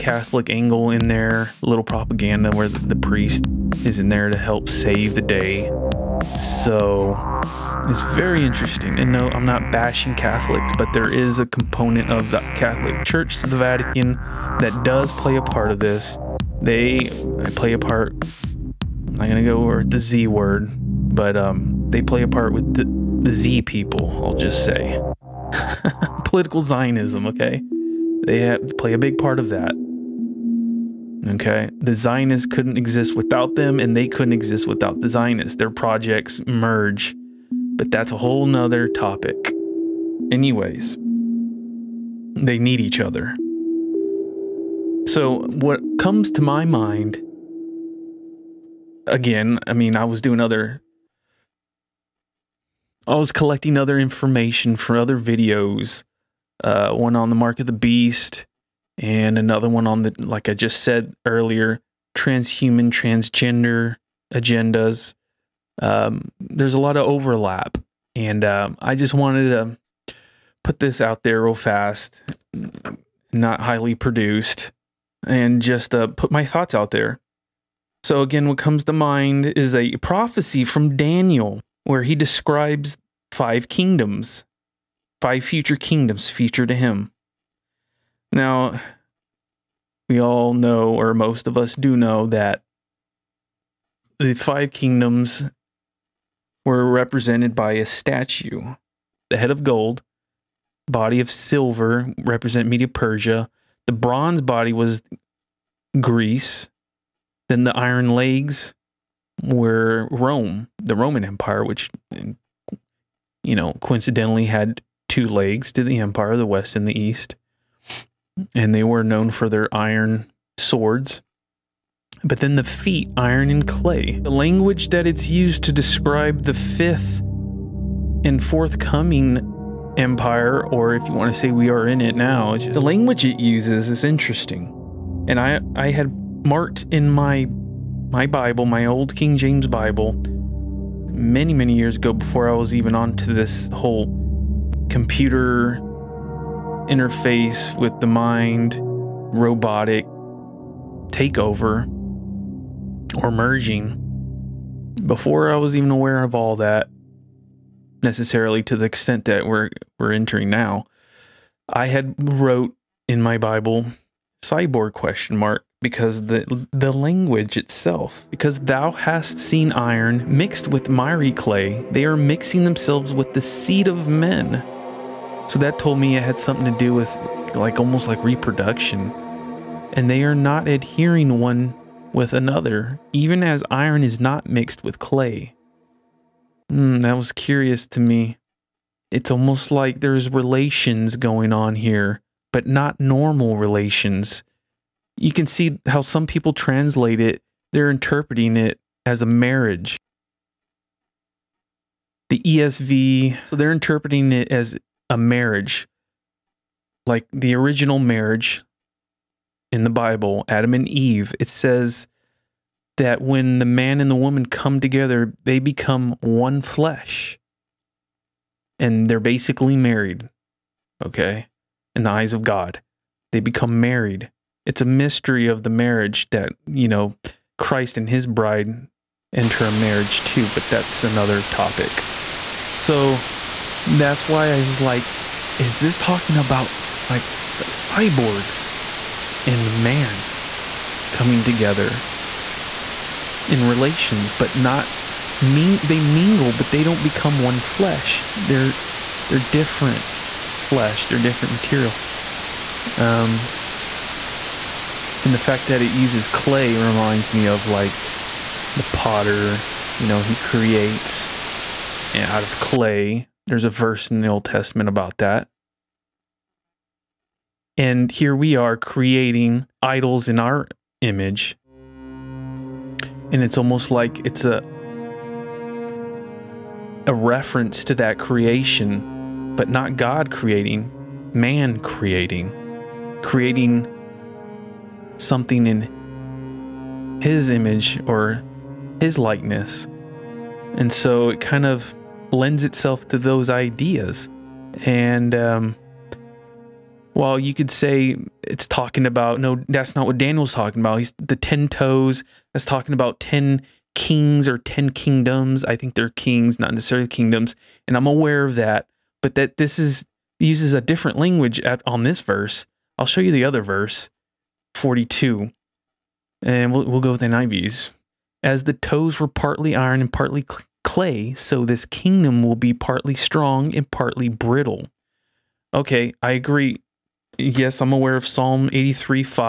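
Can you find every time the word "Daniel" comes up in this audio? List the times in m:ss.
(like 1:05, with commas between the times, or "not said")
1:20, 5:00.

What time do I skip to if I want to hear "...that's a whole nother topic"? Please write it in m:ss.
0:37.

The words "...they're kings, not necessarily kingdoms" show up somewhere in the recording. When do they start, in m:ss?
5:05.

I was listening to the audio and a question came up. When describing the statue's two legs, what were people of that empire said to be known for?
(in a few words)
iron swords.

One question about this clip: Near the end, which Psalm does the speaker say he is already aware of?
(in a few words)
Psalm 83.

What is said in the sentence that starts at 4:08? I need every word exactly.
They're they're different flesh, they're different material.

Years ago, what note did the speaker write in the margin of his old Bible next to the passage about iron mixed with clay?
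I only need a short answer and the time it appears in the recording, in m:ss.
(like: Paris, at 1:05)
cyborg question mark, at 2:44.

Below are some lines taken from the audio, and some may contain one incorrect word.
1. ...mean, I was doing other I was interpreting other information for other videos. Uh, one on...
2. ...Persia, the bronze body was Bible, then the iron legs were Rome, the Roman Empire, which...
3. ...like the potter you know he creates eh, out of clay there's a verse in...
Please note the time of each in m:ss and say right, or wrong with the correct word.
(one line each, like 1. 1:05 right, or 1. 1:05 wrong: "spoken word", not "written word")
1. 0:49 wrong: "collecting", not "interpreting"
2. 1:42 wrong: "Greece", not "Bible"
3. 4:17 right.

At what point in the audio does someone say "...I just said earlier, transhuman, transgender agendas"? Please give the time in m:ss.
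1:00.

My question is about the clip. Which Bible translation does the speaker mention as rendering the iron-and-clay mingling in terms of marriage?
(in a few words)
ESV.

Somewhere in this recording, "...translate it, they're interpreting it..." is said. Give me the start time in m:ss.
3:16.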